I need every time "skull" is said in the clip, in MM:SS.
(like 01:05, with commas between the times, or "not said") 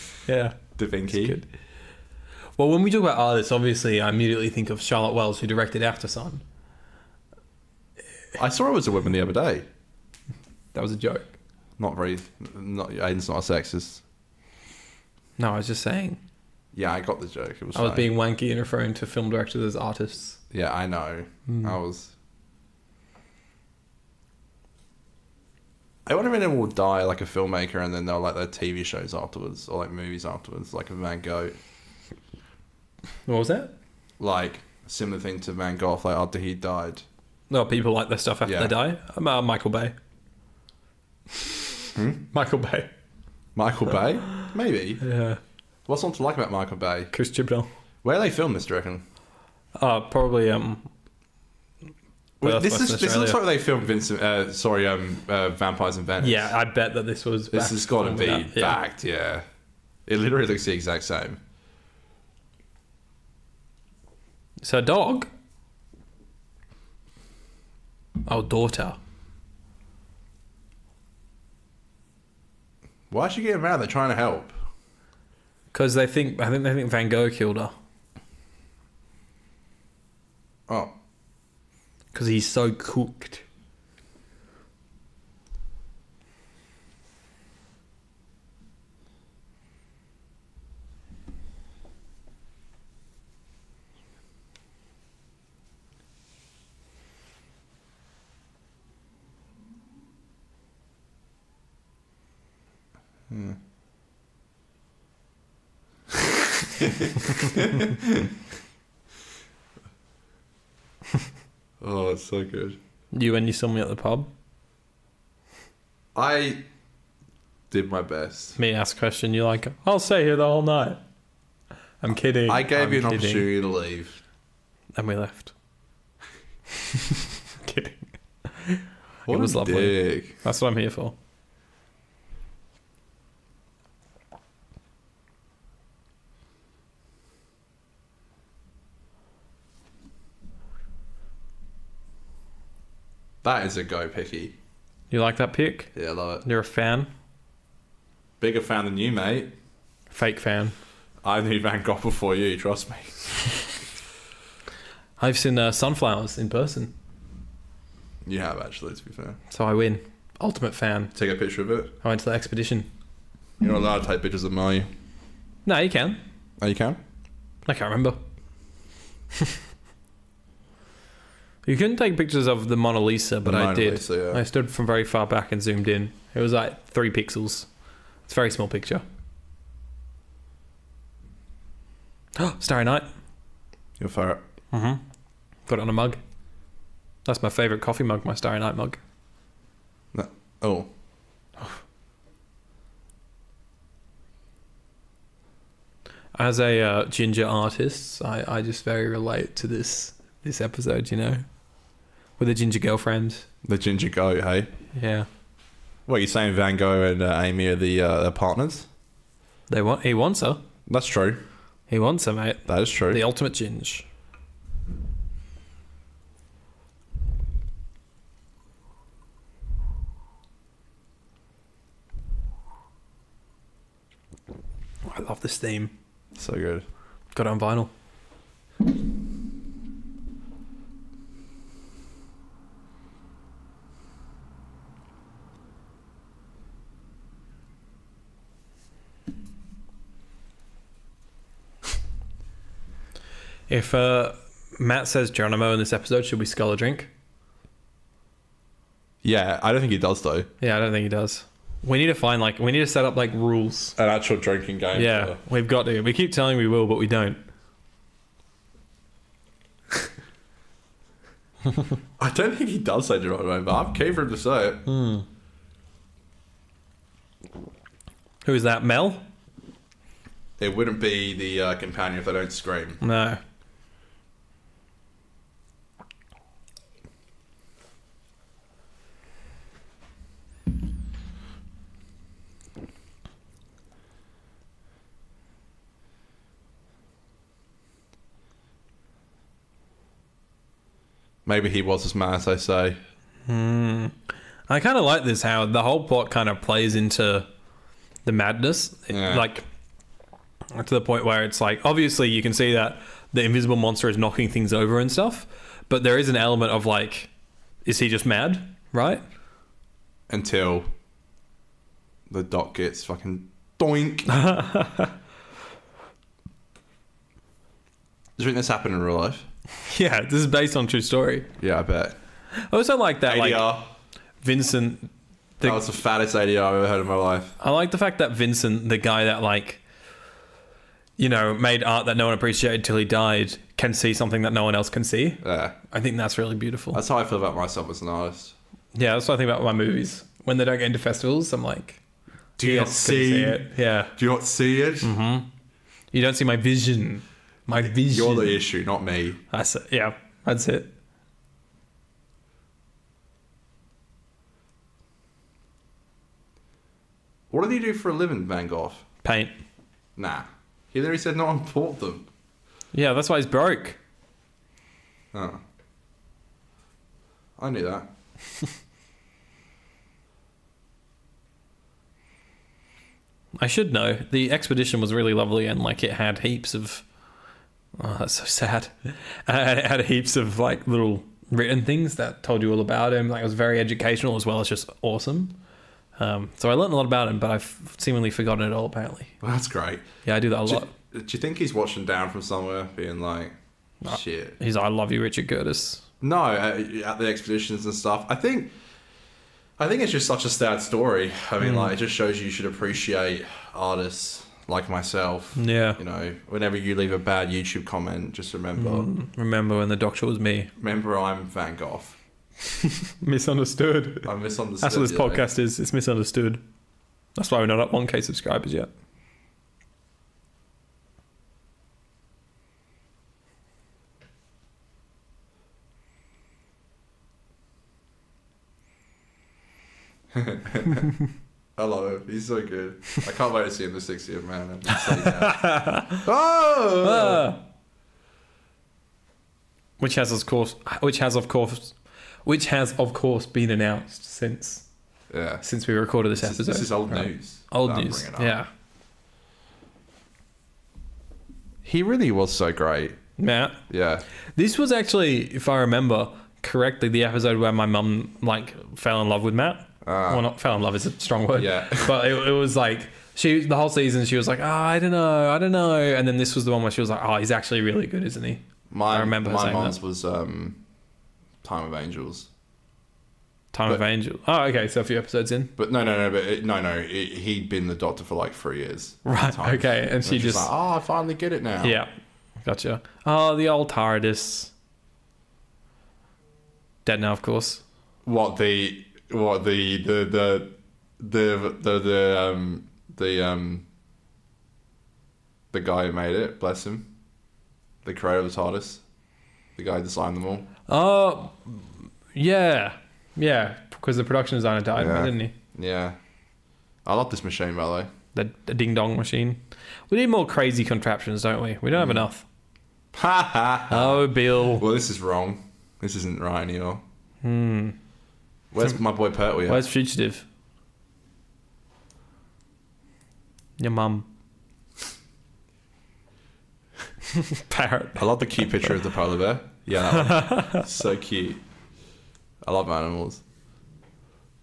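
04:06.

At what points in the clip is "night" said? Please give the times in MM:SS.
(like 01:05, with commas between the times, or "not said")
02:00, 03:02, 03:08.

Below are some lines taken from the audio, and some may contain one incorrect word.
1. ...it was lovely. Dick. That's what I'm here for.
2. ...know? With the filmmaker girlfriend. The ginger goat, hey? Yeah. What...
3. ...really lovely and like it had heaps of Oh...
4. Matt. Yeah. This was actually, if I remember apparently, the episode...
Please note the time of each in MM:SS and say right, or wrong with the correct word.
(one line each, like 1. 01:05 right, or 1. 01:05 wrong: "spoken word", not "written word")
1. 02:09 right
2. 03:21 wrong: "ginger", not "filmmaker"
3. 06:15 right
4. 07:33 wrong: "correctly", not "apparently".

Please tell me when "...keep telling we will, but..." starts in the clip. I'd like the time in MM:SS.
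04:16.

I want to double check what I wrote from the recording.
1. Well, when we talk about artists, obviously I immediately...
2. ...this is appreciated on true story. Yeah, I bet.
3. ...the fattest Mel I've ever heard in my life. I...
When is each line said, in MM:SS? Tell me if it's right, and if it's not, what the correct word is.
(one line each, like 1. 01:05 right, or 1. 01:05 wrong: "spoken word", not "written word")
1. 00:02 right
2. 05:20 wrong: "based", not "appreciated"
3. 05:25 wrong: "ADR", not "Mel".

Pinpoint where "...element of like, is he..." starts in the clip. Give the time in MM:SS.
05:06.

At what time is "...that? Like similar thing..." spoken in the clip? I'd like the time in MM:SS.
00:33.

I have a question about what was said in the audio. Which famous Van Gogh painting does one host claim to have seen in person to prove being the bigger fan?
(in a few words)
Sunflowers.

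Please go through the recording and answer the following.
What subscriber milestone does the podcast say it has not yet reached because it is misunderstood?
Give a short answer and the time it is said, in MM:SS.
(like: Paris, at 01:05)
1k, at 06:57.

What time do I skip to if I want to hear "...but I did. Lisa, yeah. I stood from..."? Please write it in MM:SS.
02:53.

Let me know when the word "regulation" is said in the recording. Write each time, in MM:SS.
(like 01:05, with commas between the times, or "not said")
not said.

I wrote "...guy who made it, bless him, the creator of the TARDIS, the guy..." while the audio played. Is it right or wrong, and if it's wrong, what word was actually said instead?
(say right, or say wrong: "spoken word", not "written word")
right.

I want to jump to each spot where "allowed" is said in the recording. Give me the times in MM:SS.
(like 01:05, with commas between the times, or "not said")
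02:43.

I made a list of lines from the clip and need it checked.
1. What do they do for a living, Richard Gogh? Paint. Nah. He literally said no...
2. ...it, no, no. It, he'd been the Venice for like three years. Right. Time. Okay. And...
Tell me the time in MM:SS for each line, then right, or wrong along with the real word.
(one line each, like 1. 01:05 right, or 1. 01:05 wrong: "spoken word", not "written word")
1. 05:57 wrong: "Van", not "Richard"
2. 07:56 wrong: "Doctor", not "Venice".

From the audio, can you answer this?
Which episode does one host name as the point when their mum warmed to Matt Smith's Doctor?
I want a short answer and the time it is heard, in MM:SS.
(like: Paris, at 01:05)
Time of Angels, at 07:51.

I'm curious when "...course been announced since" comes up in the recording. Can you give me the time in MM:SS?
07:23.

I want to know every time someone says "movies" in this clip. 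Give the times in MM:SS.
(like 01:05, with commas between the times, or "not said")
00:29, 05:39.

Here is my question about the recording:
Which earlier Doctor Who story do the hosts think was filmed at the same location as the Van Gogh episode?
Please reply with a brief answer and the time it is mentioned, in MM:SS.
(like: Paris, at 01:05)
Vampires in Venice, at 00:55.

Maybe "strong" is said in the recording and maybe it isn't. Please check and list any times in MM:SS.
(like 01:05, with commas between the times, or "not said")
07:41.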